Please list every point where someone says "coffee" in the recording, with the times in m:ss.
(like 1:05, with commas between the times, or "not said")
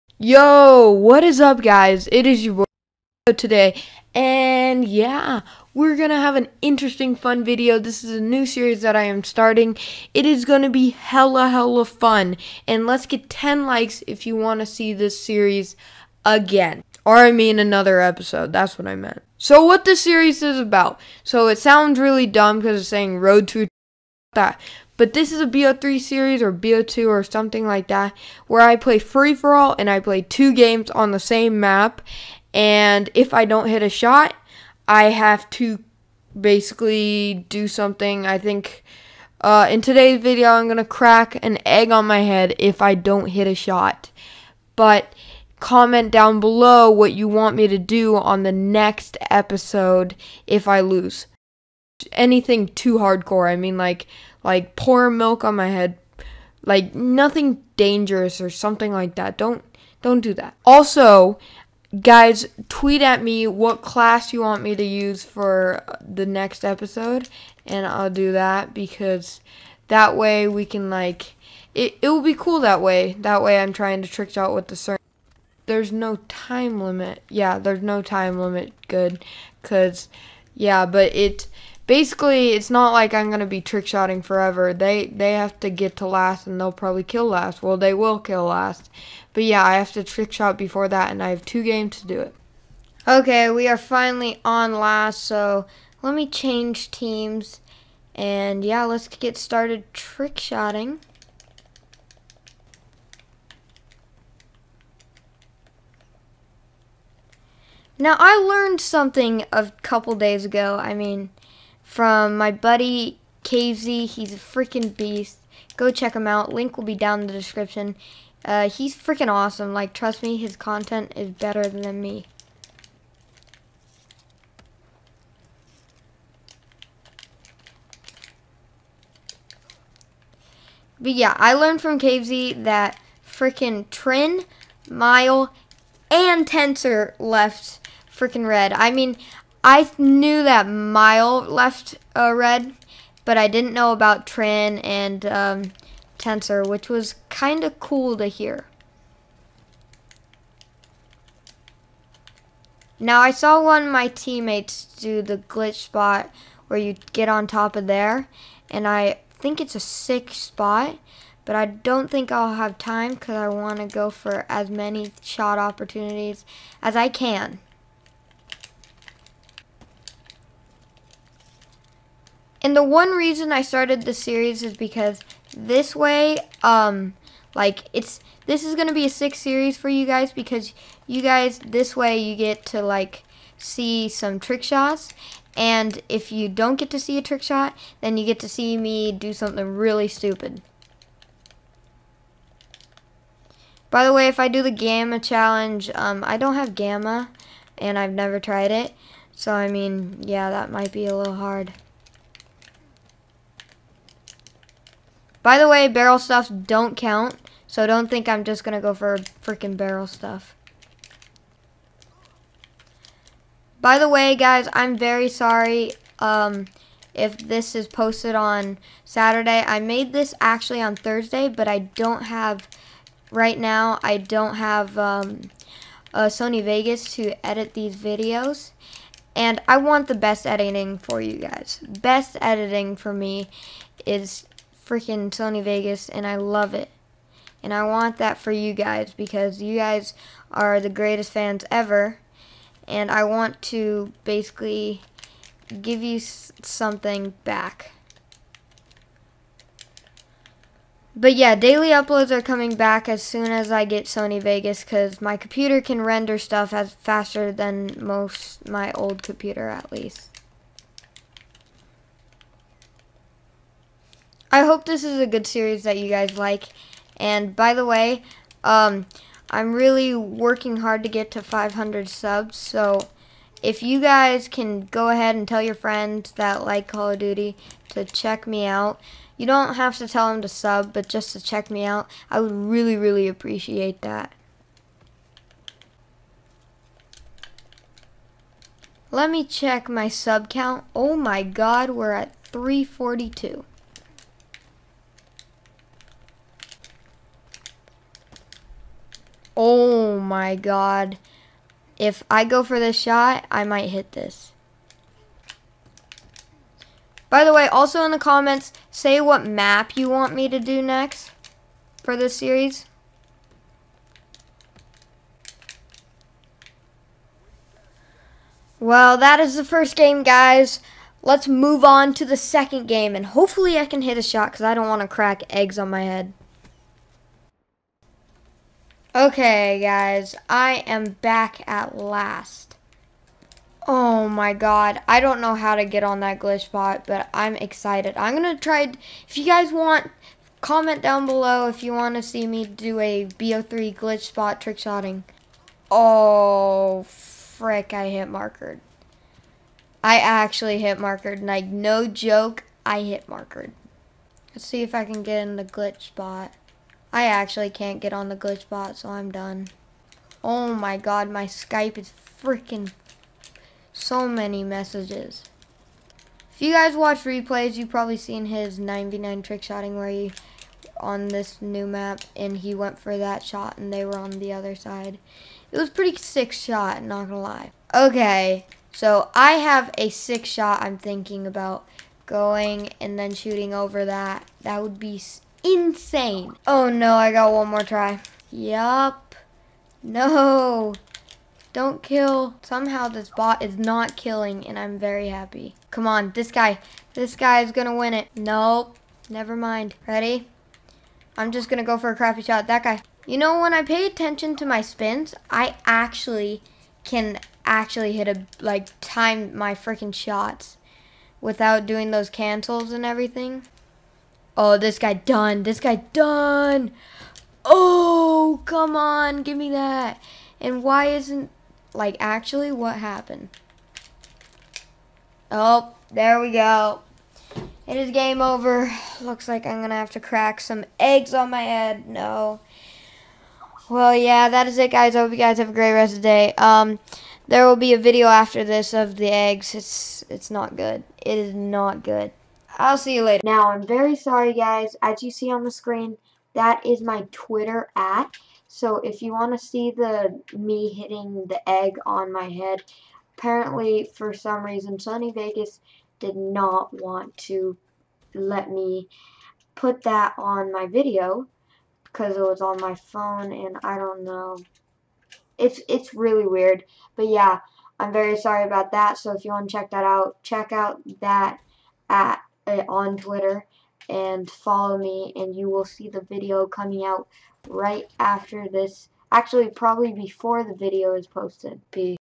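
not said.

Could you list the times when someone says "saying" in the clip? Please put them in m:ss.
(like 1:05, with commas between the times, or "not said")
0:22.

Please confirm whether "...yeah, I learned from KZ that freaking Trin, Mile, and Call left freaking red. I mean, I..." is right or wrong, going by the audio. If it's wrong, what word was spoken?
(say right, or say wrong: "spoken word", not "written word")
wrong: "Tensor", not "Call".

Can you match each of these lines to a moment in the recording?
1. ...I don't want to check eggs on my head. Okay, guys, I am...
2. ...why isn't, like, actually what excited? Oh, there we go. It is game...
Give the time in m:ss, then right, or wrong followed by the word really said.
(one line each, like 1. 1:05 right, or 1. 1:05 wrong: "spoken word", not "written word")
1. 5:24 wrong: "crack", not "check"
2. 7:00 wrong: "happened", not "excited".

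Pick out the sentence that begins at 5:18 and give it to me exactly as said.
Well, that is the first game, guys.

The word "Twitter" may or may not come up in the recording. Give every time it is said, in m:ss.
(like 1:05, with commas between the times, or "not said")
7:27, 7:53.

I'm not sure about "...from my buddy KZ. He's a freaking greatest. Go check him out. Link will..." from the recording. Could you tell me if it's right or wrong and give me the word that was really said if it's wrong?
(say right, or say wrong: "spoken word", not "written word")
wrong: "beast", not "greatest".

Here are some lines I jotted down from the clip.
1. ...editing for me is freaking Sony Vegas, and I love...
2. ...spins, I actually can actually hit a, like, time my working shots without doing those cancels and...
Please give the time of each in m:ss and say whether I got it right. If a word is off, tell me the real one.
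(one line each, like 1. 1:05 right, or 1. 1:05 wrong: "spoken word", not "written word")
1. 3:52 right
2. 6:44 wrong: "freaking", not "working".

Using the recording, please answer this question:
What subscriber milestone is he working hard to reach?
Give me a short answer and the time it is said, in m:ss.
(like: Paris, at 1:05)
500, at 4:31.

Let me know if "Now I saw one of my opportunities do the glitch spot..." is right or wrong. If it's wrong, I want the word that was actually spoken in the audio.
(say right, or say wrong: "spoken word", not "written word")
wrong: "teammates", not "opportunities".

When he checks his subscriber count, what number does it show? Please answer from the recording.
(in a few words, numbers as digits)
342.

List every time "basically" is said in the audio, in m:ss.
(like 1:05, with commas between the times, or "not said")
0:36, 1:21, 4:04.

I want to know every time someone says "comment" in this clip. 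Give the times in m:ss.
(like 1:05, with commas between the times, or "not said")
0:45, 5:08, 5:40.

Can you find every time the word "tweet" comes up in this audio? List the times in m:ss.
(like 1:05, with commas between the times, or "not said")
1:02.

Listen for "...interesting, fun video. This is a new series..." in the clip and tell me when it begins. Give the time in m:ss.
0:06.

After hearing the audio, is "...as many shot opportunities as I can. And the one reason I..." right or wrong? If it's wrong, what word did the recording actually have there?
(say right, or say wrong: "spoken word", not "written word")
right.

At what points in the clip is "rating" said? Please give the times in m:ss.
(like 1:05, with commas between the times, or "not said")
not said.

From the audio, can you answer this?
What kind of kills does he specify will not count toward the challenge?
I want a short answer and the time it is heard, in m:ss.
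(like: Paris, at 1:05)
Barrel stuffs, at 3:25.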